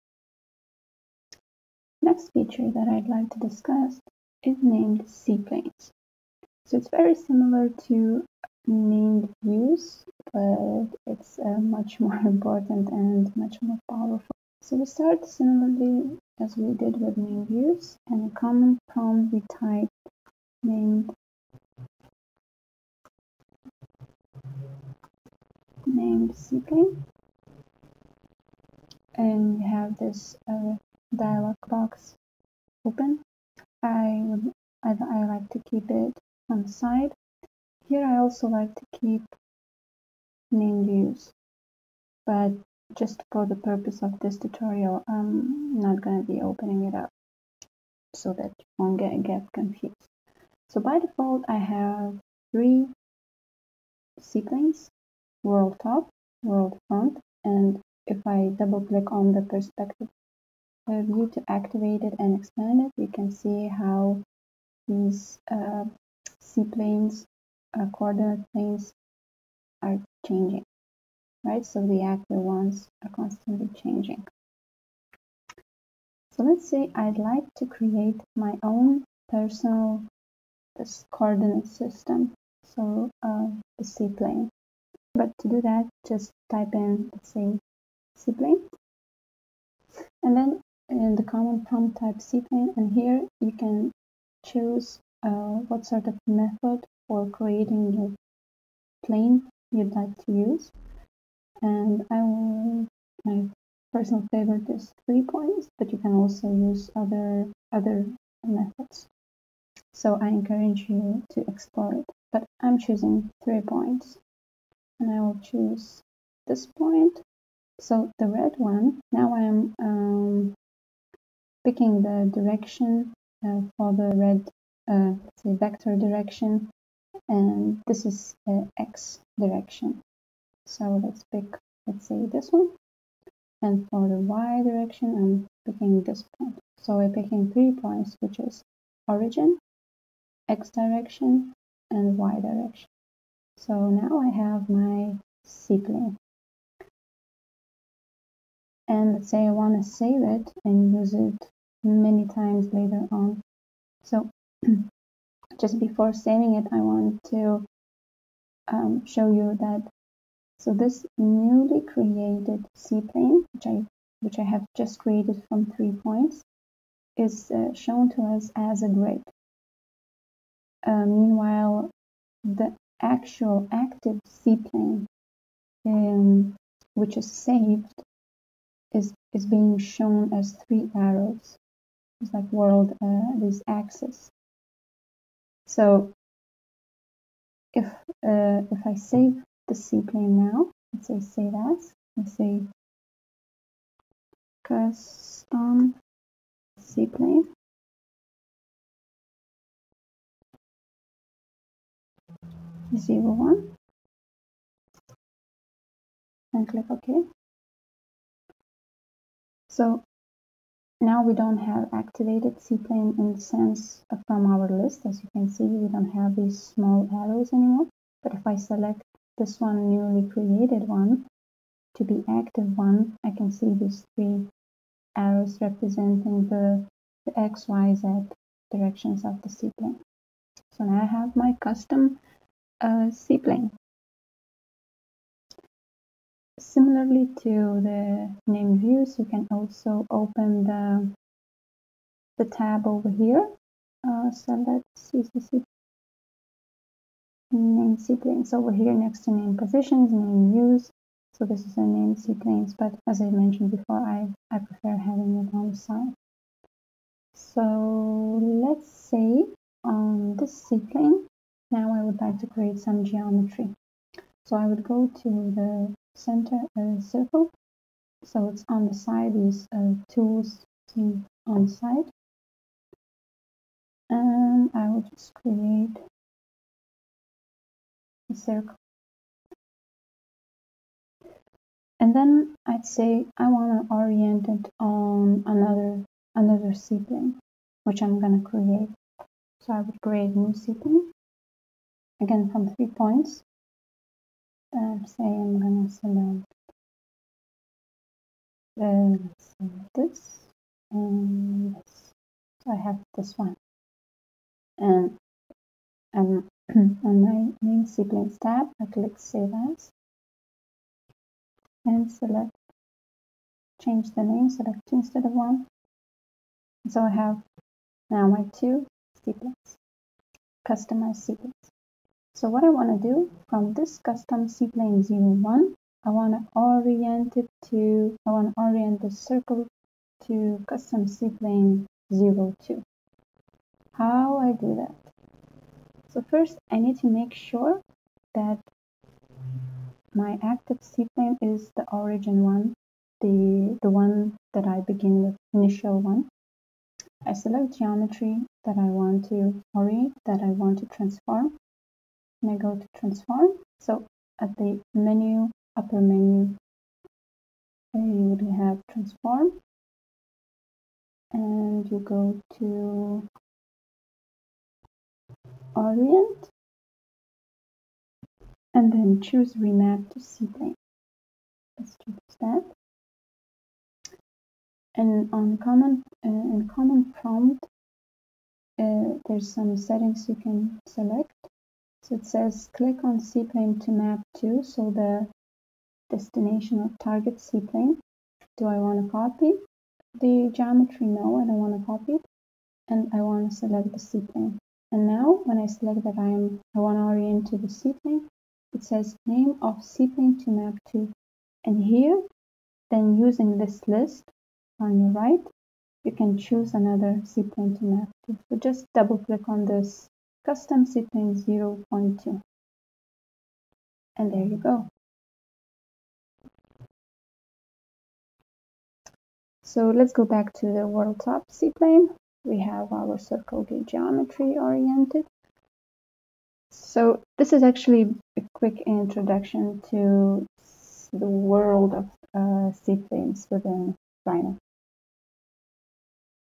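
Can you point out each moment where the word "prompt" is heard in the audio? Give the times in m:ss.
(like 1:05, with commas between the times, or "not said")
0:18, 1:31, 6:17.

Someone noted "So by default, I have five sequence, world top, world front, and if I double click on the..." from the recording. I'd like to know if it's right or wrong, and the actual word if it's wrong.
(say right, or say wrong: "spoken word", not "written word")
wrong: "three", not "five".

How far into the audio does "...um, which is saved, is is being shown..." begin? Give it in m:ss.
2:55.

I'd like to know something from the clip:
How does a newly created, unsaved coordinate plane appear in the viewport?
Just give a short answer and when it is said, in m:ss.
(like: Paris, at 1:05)
as a grid, at 2:48.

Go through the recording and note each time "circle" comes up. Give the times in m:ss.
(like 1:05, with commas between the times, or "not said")
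4:27, 4:38, 5:29, 7:03.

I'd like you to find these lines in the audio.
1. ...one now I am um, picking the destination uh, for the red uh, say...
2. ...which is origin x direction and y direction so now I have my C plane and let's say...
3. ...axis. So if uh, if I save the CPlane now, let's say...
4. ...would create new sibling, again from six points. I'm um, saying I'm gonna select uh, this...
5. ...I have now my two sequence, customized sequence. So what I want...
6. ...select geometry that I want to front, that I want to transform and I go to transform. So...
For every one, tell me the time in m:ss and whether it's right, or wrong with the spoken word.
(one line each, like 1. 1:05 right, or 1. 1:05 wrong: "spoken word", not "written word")
1. 1:58 wrong: "direction", not "destination"
2. 2:18 right
3. 3:03 right
4. 4:49 wrong: "three", not "six"
5. 5:17 right
6. 5:47 wrong: "orient", not "front".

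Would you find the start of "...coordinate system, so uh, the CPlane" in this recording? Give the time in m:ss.
1:21.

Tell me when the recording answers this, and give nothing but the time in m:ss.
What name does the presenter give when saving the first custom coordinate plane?
3:14.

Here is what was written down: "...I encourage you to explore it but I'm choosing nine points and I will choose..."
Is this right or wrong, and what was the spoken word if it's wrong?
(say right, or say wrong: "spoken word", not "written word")
wrong: "three", not "nine".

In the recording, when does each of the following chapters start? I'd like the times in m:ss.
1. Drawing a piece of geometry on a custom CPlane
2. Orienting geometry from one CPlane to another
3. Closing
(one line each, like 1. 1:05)
1. 3:55
2. 5:35
3. 6:55.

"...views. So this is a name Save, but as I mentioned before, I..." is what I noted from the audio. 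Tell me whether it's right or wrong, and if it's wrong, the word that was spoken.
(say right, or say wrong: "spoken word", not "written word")
wrong: "CPlanes", not "Save".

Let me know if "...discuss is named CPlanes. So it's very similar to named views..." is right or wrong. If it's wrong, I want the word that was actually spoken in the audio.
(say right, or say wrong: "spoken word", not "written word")
right.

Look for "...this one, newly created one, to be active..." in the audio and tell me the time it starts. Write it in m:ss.
3:39.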